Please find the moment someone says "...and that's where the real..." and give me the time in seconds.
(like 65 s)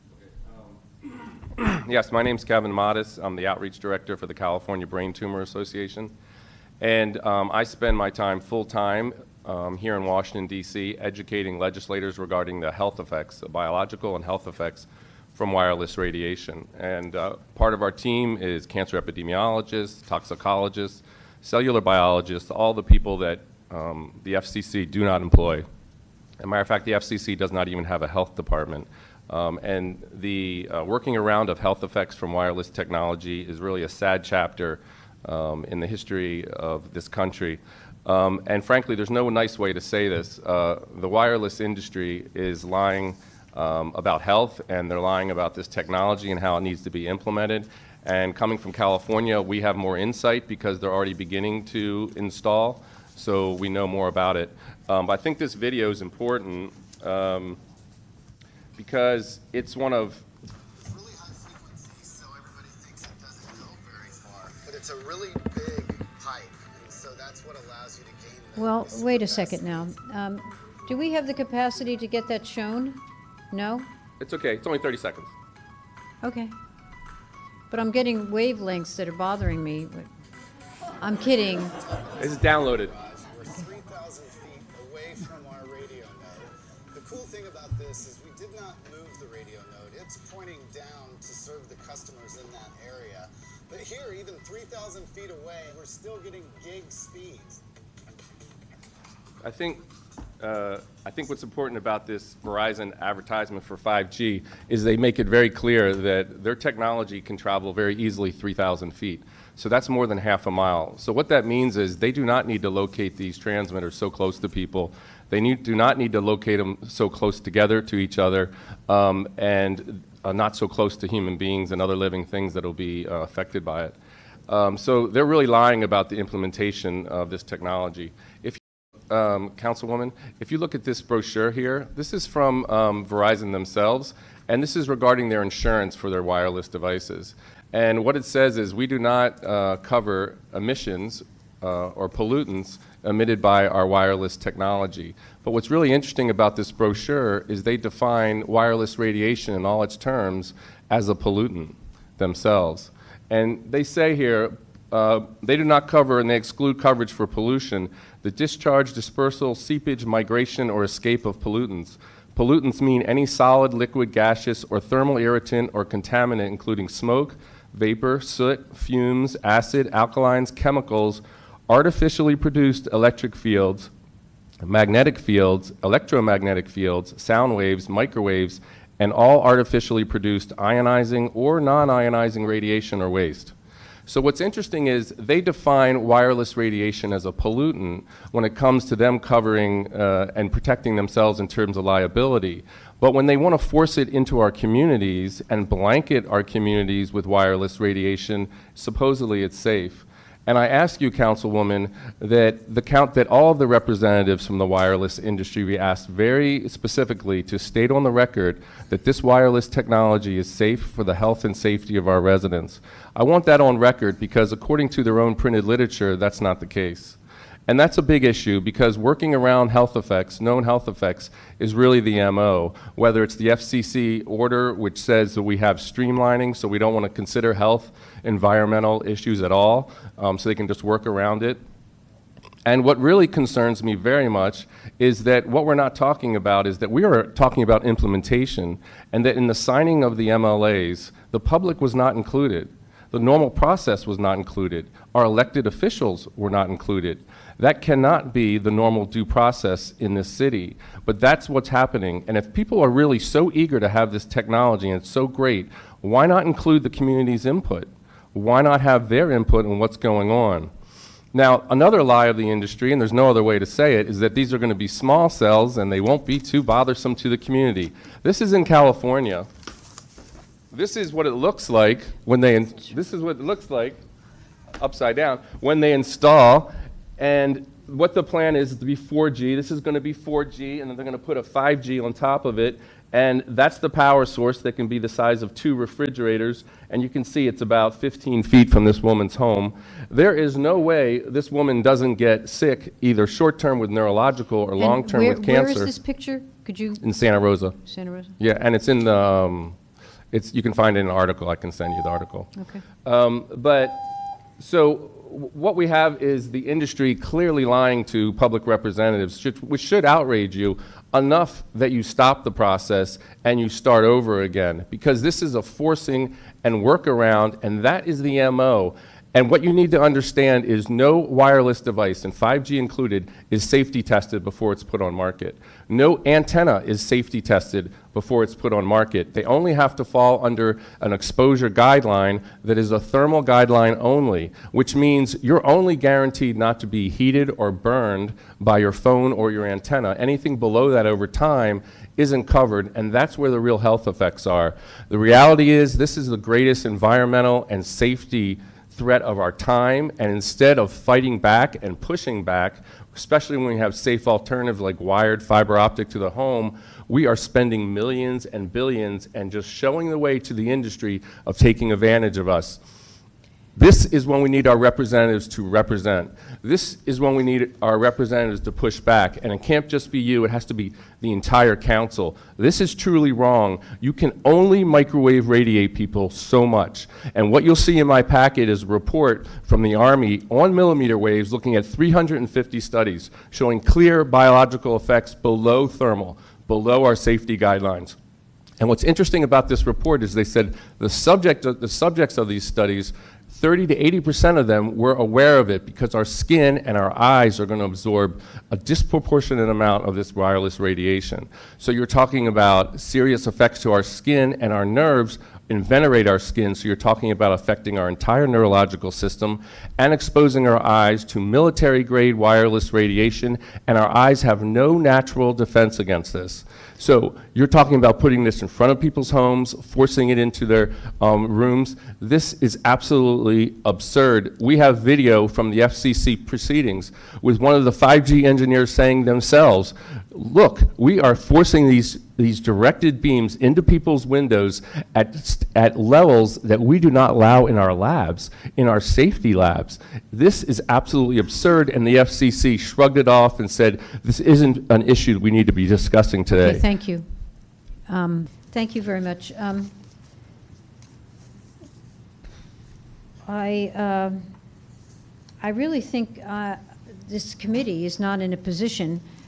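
342 s.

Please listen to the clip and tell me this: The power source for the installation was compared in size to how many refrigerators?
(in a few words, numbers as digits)
2.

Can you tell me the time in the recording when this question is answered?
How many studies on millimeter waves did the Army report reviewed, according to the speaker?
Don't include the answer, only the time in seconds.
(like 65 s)
381 s.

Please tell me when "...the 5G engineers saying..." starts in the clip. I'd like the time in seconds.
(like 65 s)
427 s.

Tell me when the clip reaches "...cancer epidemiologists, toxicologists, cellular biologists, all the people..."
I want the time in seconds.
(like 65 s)
18 s.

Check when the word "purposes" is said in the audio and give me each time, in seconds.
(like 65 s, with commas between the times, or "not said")
not said.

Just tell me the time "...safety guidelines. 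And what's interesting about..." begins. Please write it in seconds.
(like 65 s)
387 s.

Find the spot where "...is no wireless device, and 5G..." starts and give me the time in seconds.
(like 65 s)
320 s.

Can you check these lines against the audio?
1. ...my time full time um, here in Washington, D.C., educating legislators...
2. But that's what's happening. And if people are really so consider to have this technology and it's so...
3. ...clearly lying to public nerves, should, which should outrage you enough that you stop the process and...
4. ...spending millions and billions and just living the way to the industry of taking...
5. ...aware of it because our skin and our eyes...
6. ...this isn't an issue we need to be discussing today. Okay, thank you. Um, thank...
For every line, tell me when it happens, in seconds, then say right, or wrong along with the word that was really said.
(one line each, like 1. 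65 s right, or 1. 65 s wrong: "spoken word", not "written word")
1. 7 s right
2. 251 s wrong: "eager", not "consider"
3. 307 s wrong: "representatives", not "nerves"
4. 357 s wrong: "showing", not "living"
5. 395 s right
6. 444 s right.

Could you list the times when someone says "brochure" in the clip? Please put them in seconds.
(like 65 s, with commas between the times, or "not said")
131 s, 146 s.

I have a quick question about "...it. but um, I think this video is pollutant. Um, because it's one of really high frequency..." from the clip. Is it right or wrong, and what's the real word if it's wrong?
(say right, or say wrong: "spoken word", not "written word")
wrong: "important", not "pollutant".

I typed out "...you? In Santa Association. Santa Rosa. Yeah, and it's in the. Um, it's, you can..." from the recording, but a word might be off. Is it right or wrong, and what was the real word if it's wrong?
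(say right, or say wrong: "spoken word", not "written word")
wrong: "Rosa", not "Association".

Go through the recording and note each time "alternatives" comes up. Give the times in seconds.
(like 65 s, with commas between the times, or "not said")
354 s.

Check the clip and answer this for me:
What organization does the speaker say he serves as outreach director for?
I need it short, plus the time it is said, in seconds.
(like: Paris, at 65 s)
California Brain Tumor Association, at 4 s.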